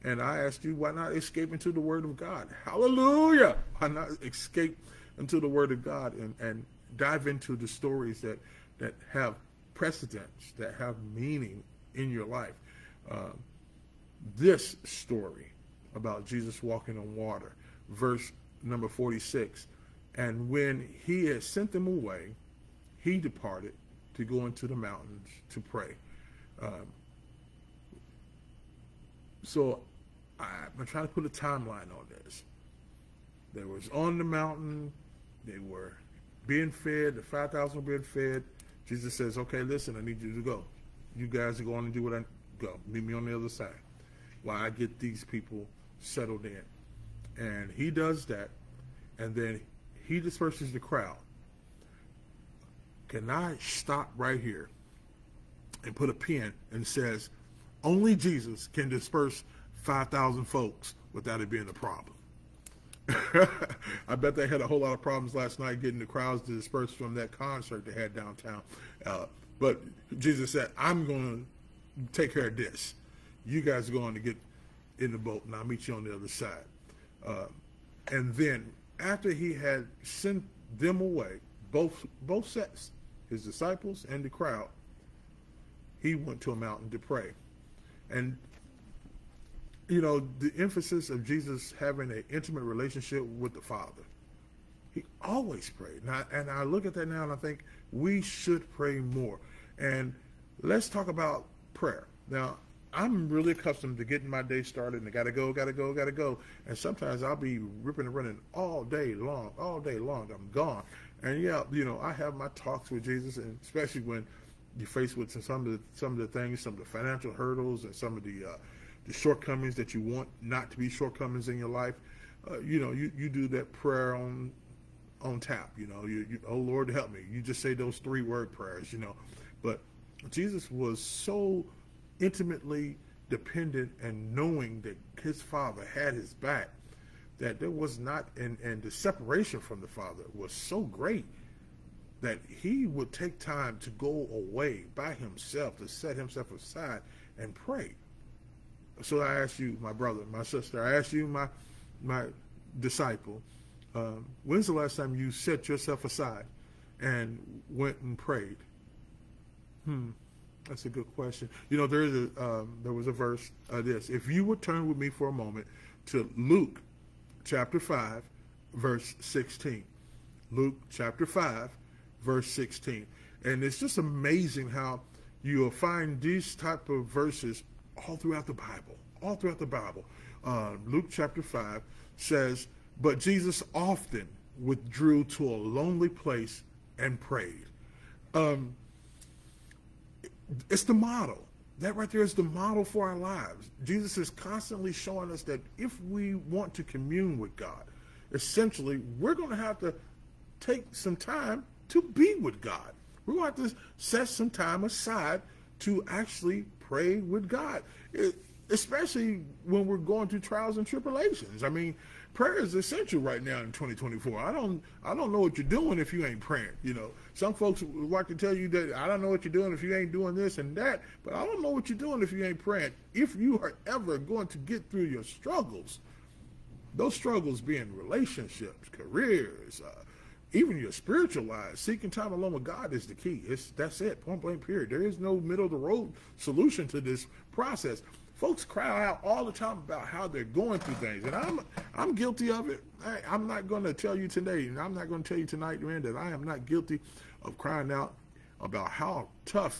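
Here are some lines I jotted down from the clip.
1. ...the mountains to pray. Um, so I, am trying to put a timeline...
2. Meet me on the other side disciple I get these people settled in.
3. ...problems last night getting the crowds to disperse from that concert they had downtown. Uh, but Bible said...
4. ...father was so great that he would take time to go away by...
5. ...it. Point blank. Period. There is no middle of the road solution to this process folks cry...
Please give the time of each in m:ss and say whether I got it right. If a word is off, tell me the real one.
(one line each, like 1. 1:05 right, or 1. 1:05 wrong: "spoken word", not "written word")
1. 0:24 right
2. 0:42 wrong: "while", not "disciple"
3. 1:05 wrong: "Jesus", not "Bible"
4. 2:19 right
5. 3:53 right.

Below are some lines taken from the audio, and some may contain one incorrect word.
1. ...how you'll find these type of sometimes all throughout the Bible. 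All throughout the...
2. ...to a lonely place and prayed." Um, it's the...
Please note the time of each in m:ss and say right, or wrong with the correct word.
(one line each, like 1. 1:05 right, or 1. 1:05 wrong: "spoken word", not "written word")
1. 2:54 wrong: "verses", not "sometimes"
2. 3:05 right.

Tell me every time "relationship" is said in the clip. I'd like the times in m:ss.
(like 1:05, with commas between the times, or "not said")
1:32, 3:47.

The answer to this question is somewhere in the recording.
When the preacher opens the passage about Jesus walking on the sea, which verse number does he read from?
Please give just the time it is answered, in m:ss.
0:17.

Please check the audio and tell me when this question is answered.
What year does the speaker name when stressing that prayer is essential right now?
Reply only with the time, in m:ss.
3:33.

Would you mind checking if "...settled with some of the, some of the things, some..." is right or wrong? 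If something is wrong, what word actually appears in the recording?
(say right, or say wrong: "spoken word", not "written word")
wrong: "faced", not "settled".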